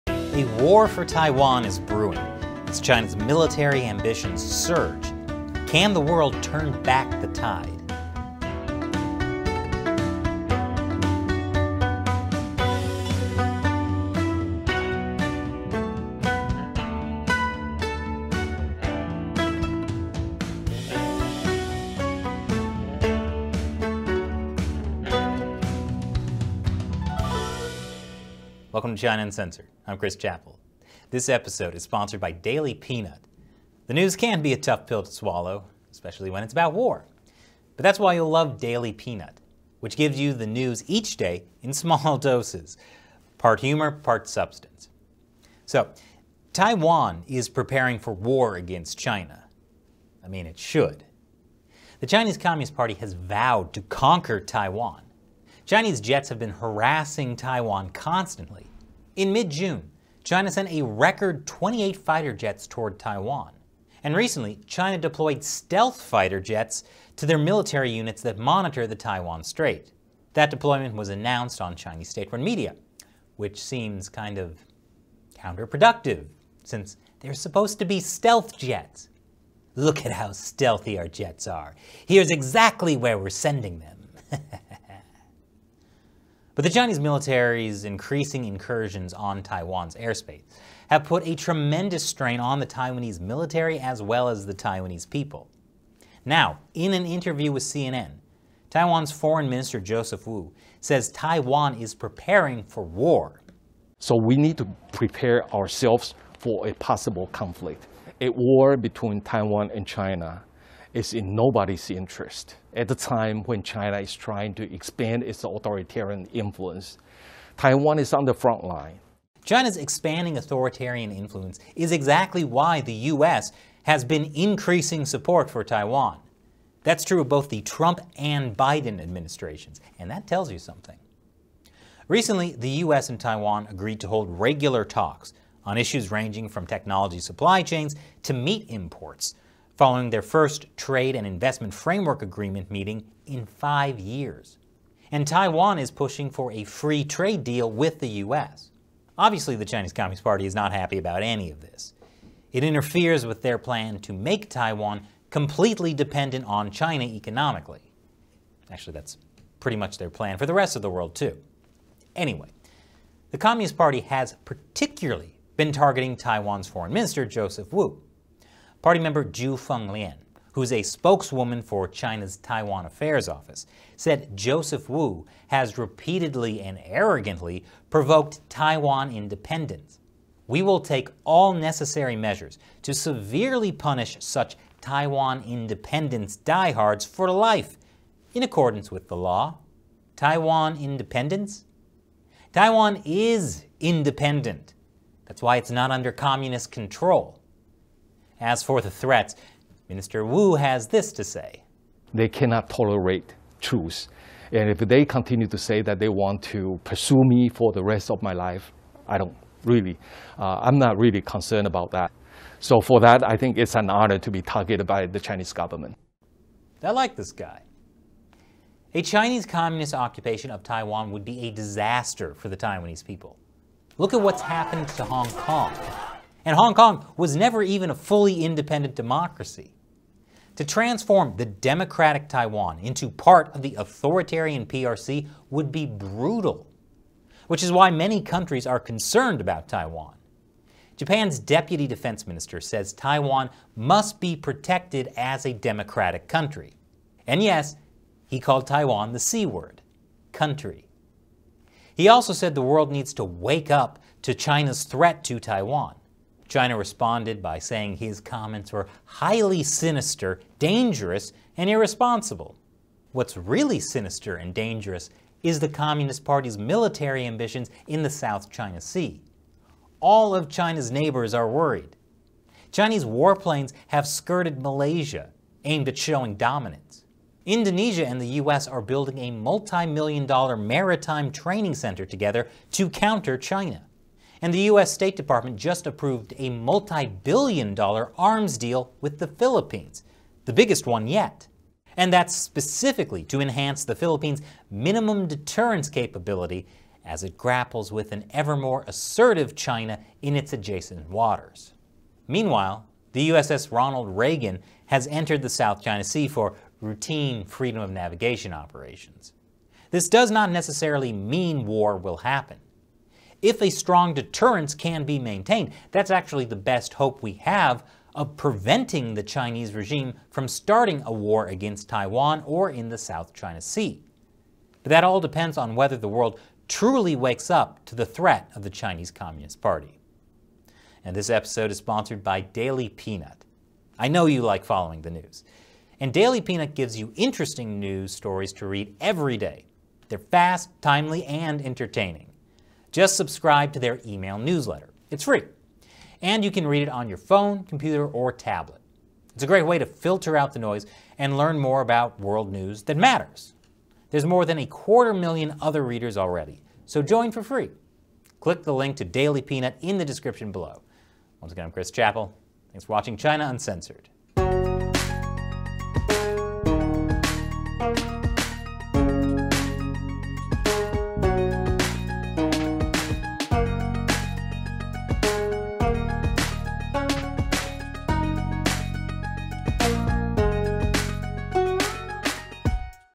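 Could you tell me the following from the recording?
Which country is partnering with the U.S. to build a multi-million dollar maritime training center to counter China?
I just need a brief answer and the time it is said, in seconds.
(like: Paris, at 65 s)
Indonesia, at 277 s.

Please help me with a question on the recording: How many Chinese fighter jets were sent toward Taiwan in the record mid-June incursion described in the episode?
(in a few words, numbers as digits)
28.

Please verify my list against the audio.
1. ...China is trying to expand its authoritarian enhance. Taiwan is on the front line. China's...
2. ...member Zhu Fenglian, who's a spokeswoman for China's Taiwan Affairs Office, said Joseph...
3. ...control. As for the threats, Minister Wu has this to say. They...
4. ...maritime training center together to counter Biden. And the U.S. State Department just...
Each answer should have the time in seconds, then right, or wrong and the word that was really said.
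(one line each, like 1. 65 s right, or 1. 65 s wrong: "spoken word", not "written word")
1. 113 s wrong: "influence", not "enhance"
2. 168 s right
3. 196 s right
4. 280 s wrong: "China", not "Biden".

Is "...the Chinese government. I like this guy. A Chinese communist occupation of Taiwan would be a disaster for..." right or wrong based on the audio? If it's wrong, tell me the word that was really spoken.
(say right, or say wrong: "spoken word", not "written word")
right.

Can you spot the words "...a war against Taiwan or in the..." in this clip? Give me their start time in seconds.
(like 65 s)
321 s.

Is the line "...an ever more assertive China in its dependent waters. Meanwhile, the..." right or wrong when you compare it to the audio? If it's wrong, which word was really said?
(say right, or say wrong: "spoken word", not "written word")
wrong: "adjacent", not "dependent".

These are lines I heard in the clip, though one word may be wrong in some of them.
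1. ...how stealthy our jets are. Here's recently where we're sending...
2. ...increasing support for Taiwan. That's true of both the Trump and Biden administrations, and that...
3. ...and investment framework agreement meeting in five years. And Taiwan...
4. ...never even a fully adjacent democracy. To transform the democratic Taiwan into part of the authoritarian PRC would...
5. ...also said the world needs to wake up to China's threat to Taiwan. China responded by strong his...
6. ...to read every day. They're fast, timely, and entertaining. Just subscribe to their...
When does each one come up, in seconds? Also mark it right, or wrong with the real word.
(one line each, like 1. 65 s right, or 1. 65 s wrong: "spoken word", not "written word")
1. 80 s wrong: "exactly", not "recently"
2. 124 s right
3. 141 s right
4. 227 s wrong: "independent", not "adjacent"
5. 252 s wrong: "saying", not "strong"
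6. 338 s right.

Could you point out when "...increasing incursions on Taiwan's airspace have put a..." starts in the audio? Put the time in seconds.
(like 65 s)
87 s.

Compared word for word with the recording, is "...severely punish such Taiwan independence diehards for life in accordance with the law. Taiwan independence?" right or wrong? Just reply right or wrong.
right.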